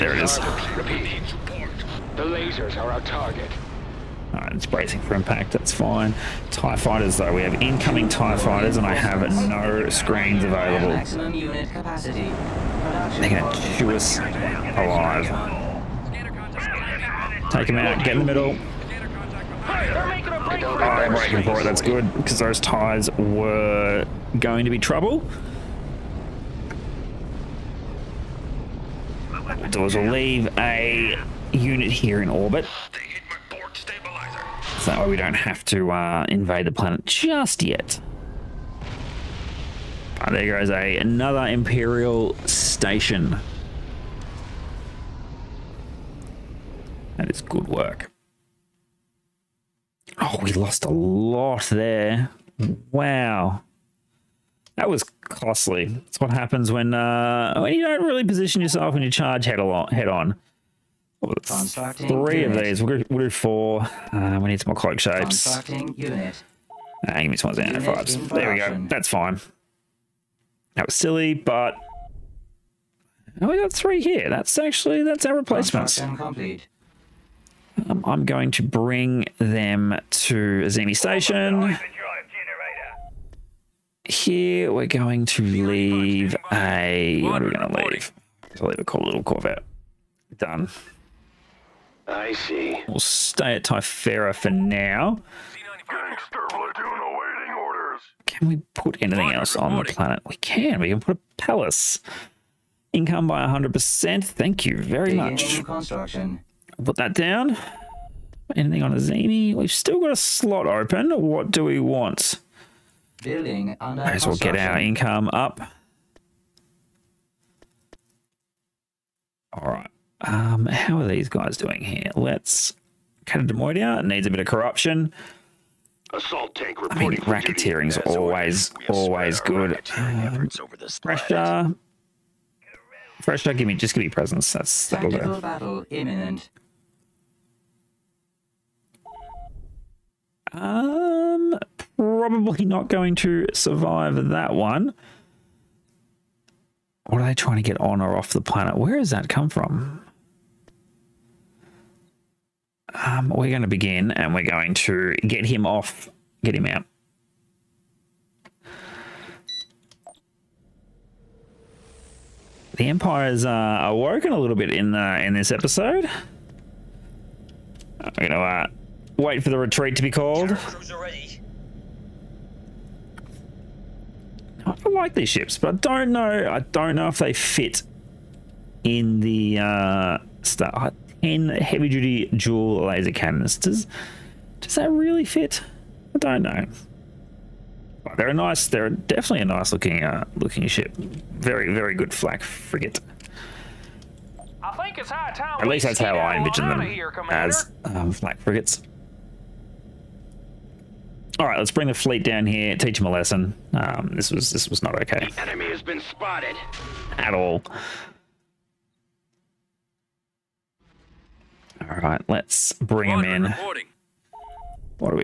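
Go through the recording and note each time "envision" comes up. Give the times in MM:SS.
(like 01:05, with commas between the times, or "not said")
03:16.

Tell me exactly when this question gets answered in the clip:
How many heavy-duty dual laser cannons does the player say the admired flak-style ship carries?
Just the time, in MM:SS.
03:01.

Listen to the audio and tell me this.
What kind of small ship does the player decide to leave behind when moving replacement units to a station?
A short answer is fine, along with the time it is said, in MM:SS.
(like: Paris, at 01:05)
Corvette, at 01:29.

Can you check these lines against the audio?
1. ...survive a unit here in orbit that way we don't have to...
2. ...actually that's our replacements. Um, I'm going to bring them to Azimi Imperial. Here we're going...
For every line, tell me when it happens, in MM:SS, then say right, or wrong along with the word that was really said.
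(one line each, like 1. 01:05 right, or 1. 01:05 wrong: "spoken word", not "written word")
1. 00:30 wrong: "leave", not "survive"
2. 01:14 wrong: "Station", not "Imperial".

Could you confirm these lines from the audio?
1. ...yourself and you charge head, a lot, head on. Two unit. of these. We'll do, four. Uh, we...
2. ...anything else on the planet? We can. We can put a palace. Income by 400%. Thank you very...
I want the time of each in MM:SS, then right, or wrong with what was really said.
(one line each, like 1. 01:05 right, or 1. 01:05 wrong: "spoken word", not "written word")
1. 00:58 wrong: "Three", not "Two"
2. 01:39 wrong: "100", not "400".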